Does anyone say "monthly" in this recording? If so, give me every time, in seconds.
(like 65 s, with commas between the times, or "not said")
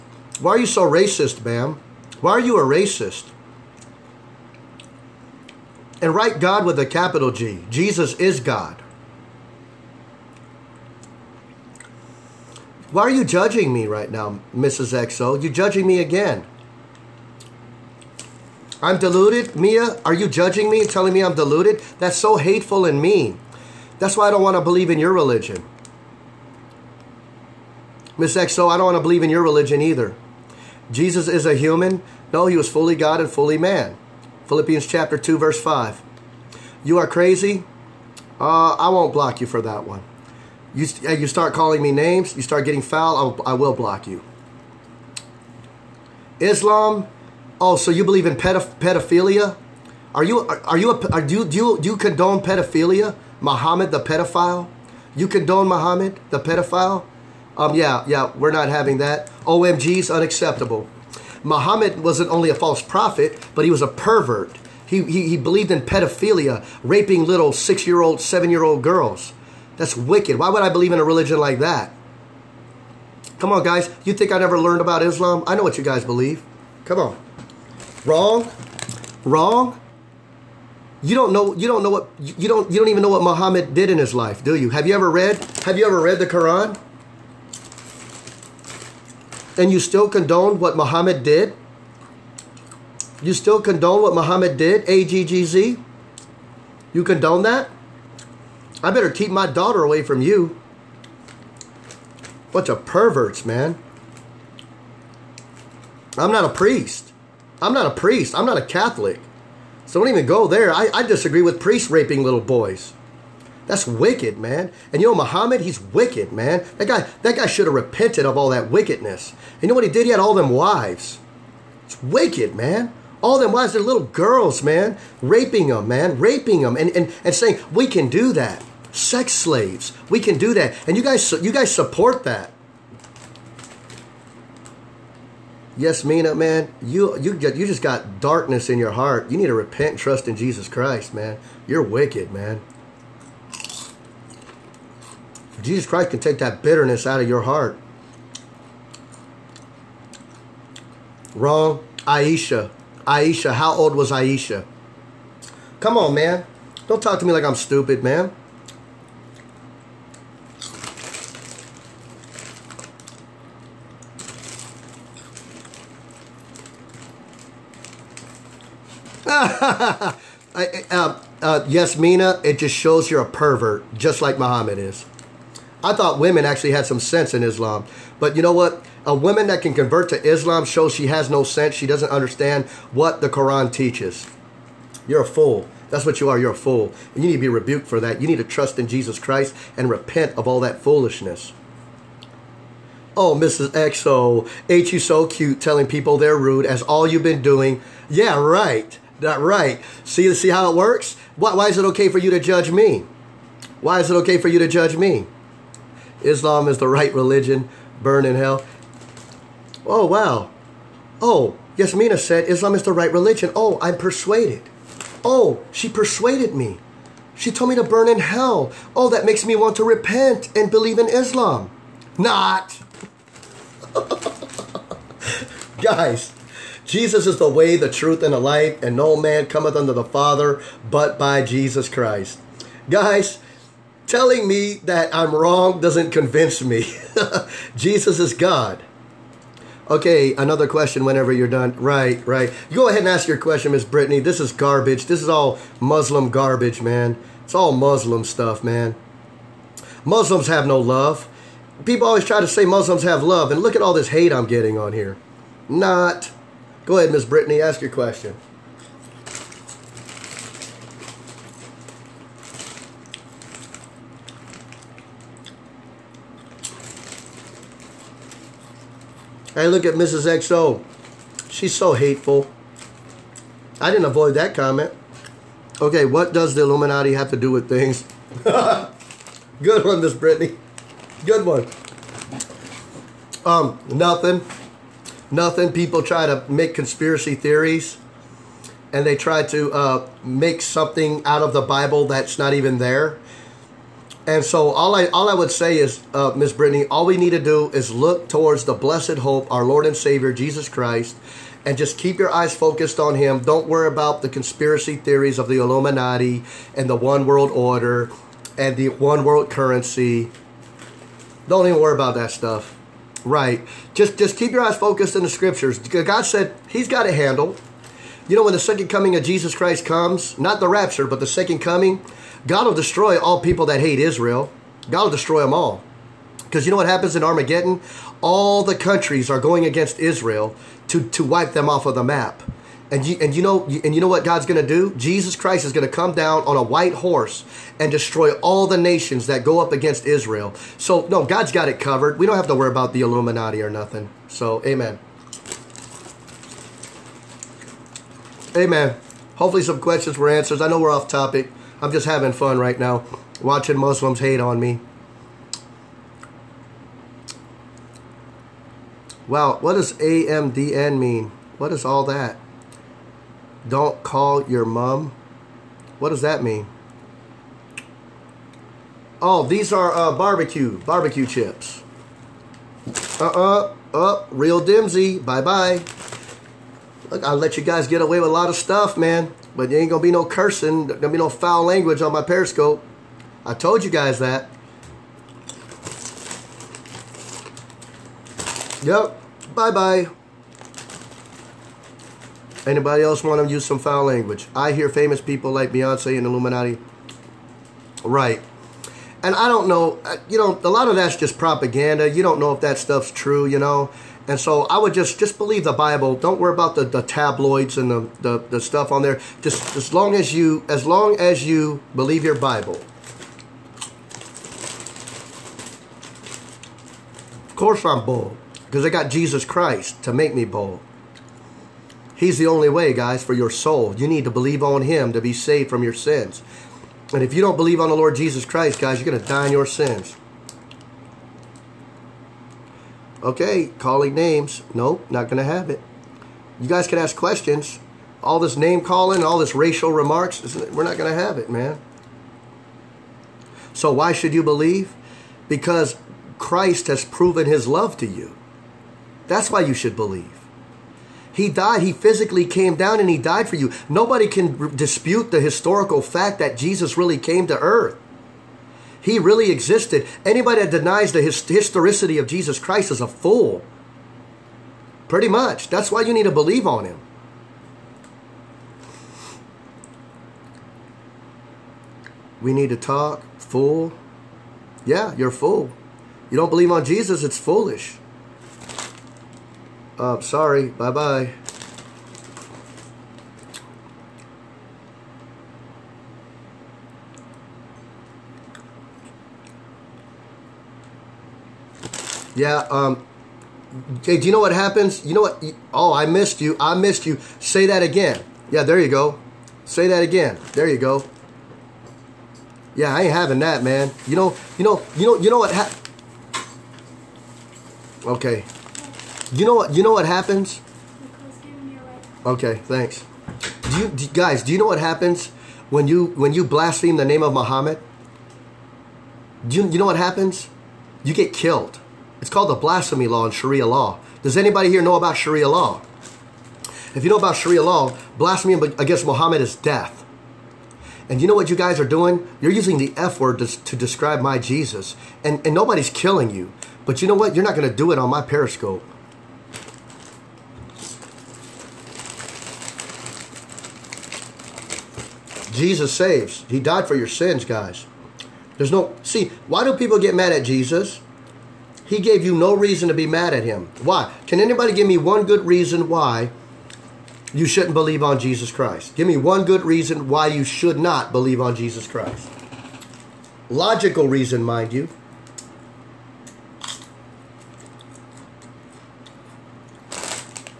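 not said.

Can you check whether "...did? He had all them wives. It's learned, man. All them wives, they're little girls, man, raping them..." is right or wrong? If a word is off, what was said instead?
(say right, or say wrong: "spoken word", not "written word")
wrong: "wicked", not "learned".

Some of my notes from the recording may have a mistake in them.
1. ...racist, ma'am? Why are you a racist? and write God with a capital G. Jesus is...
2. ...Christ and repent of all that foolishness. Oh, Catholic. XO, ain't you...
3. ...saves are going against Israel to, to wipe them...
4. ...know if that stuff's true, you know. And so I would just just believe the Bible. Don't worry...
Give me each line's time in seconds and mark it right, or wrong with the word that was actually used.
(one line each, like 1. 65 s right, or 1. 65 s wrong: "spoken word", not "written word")
1. 0 s right
2. 189 s wrong: "Mrs", not "Catholic"
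3. 328 s wrong: "countries", not "saves"
4. 402 s right.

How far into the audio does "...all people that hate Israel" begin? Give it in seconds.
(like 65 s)
323 s.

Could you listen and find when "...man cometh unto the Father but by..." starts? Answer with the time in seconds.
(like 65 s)
229 s.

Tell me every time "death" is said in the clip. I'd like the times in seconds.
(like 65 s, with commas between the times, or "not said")
529 s.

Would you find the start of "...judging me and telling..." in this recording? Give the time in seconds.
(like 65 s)
20 s.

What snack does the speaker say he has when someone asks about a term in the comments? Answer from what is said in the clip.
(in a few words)
Barbecue chips.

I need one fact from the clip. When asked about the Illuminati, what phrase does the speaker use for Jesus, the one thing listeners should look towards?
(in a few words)
The blessed hope.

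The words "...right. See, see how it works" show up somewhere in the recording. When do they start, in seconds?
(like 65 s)
199 s.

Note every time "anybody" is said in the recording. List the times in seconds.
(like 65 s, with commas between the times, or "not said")
392 s, 460 s, 524 s, 554 s.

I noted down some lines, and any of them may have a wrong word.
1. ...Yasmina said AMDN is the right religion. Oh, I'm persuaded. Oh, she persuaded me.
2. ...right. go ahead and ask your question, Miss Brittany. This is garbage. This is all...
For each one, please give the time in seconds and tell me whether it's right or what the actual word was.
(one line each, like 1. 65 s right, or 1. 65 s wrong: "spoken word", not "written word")
1. 211 s wrong: "Islam", not "AMDN"
2. 242 s right.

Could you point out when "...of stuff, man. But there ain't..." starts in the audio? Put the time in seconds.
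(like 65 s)
378 s.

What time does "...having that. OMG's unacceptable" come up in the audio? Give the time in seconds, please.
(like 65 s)
58 s.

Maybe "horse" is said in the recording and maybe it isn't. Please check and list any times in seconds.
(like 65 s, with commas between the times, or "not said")
336 s.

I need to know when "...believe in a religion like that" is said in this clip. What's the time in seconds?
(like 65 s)
70 s.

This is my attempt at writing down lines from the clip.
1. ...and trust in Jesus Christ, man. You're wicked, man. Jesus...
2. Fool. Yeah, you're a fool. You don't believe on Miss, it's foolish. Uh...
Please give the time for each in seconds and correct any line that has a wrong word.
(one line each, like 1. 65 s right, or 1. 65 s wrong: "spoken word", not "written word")
1. 139 s right
2. 473 s wrong: "Jesus", not "Miss".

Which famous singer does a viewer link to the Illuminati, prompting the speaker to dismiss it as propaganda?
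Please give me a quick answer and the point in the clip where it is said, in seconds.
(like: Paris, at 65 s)
Beyonce, at 395 s.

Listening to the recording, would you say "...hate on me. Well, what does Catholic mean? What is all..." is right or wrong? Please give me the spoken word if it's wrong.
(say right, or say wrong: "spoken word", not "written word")
wrong: "AMDN", not "Catholic".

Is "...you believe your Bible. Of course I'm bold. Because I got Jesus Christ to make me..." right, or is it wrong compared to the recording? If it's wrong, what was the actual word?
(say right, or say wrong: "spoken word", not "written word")
right.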